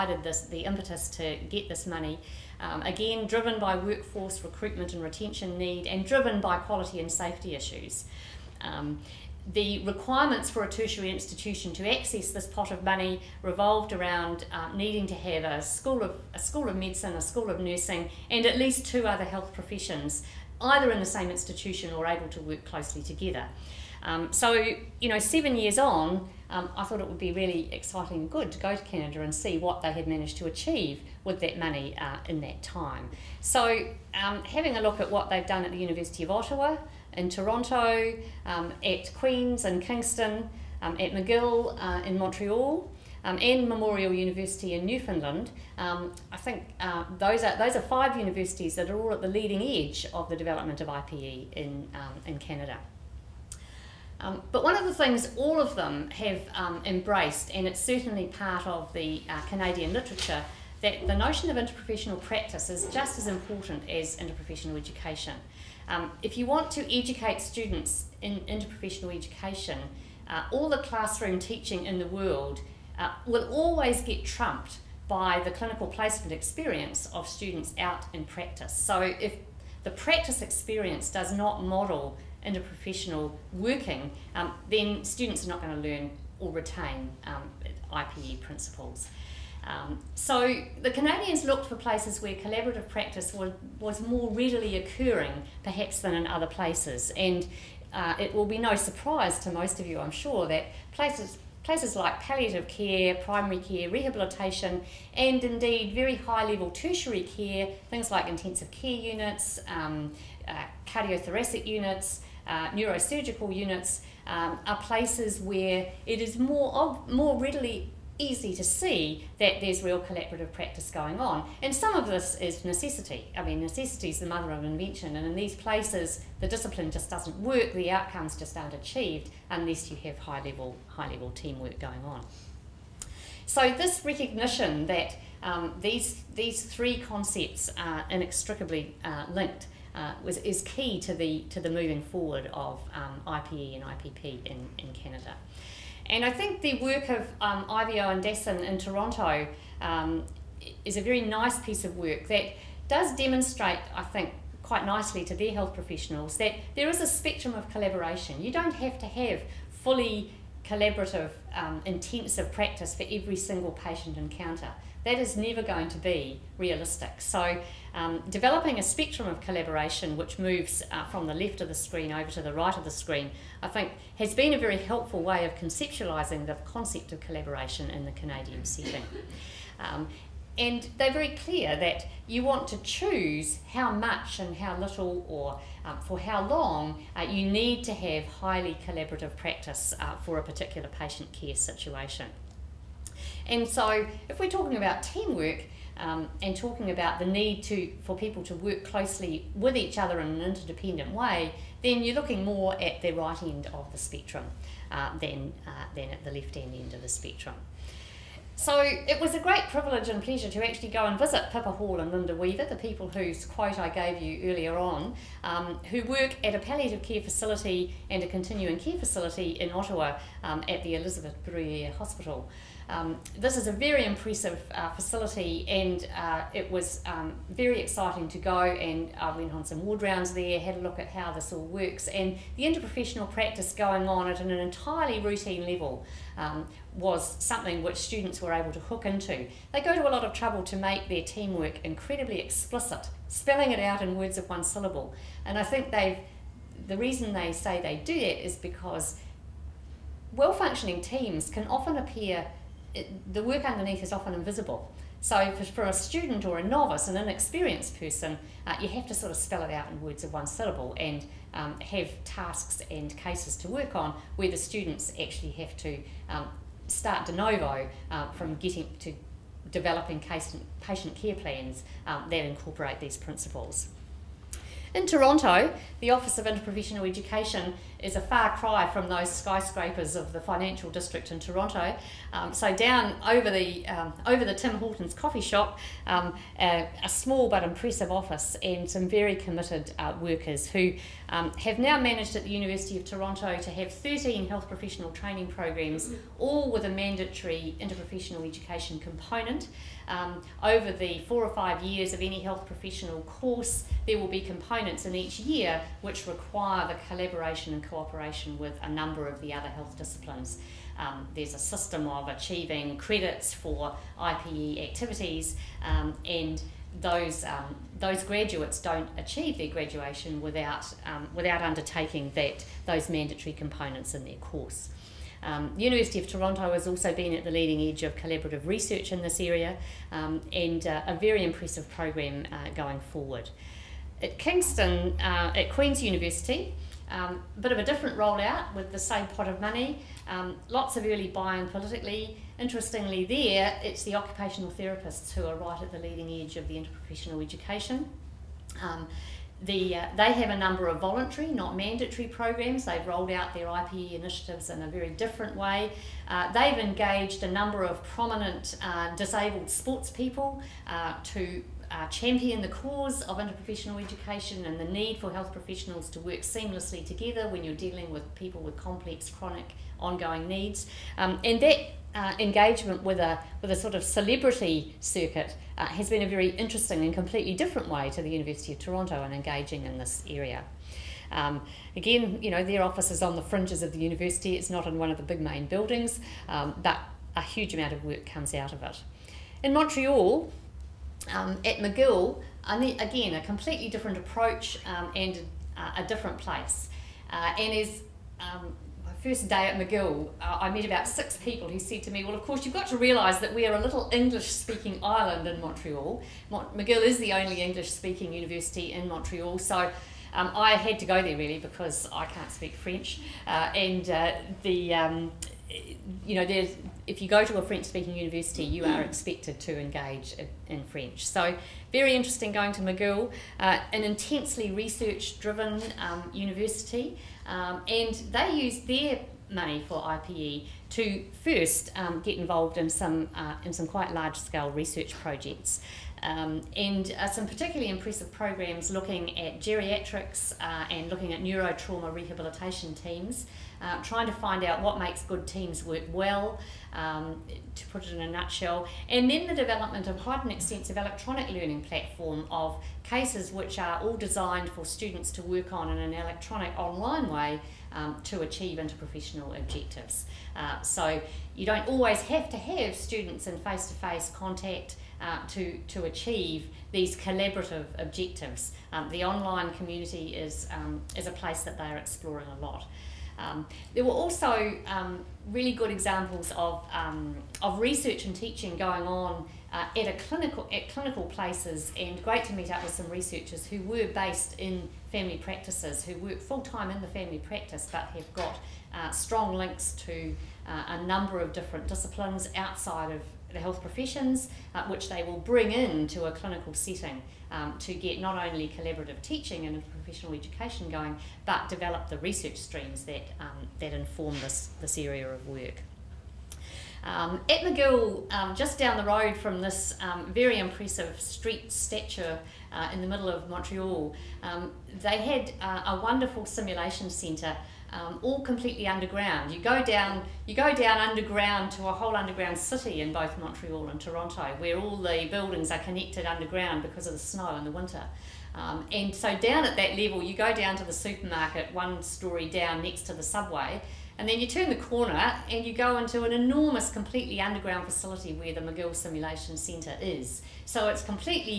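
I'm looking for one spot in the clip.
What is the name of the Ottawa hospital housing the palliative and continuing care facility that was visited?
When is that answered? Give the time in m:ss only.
3:40.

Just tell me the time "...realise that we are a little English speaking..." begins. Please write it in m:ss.
6:42.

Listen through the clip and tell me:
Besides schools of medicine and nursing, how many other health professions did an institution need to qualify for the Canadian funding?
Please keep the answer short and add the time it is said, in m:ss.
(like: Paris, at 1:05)
2, at 0:18.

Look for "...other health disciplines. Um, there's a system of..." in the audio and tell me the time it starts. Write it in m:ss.
5:09.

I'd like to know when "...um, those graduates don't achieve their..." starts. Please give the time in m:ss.
5:17.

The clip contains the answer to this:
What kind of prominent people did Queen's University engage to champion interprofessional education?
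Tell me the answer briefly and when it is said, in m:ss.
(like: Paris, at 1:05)
Disabled sports people, at 5:59.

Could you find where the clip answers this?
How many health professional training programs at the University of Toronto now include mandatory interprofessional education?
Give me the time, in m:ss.
4:53.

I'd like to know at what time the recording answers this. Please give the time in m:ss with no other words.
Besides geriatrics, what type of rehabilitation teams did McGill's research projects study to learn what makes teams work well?
7:21.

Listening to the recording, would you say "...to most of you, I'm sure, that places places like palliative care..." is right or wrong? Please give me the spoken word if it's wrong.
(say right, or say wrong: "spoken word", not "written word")
right.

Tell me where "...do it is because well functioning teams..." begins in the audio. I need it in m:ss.
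4:08.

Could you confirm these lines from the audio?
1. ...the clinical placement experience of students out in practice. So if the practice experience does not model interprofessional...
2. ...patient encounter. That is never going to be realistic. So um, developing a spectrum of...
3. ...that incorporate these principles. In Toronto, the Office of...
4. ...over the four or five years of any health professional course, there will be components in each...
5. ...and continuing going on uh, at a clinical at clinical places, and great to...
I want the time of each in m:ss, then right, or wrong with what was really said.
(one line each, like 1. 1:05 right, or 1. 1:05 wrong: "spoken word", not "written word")
1. 1:15 right
2. 2:43 right
3. 4:32 right
4. 5:00 right
5. 7:58 wrong: "teaching", not "continuing".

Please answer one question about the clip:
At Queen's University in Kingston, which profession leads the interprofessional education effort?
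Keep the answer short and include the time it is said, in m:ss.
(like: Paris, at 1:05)
Occupational therapists, at 5:44.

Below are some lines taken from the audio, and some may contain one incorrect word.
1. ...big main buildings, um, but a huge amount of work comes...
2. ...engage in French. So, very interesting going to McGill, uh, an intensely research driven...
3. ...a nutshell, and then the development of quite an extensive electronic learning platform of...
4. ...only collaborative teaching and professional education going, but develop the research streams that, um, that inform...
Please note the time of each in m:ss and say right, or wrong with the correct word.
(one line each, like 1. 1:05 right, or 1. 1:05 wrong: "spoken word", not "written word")
1. 6:25 right
2. 6:59 right
3. 7:28 right
4. 8:18 right.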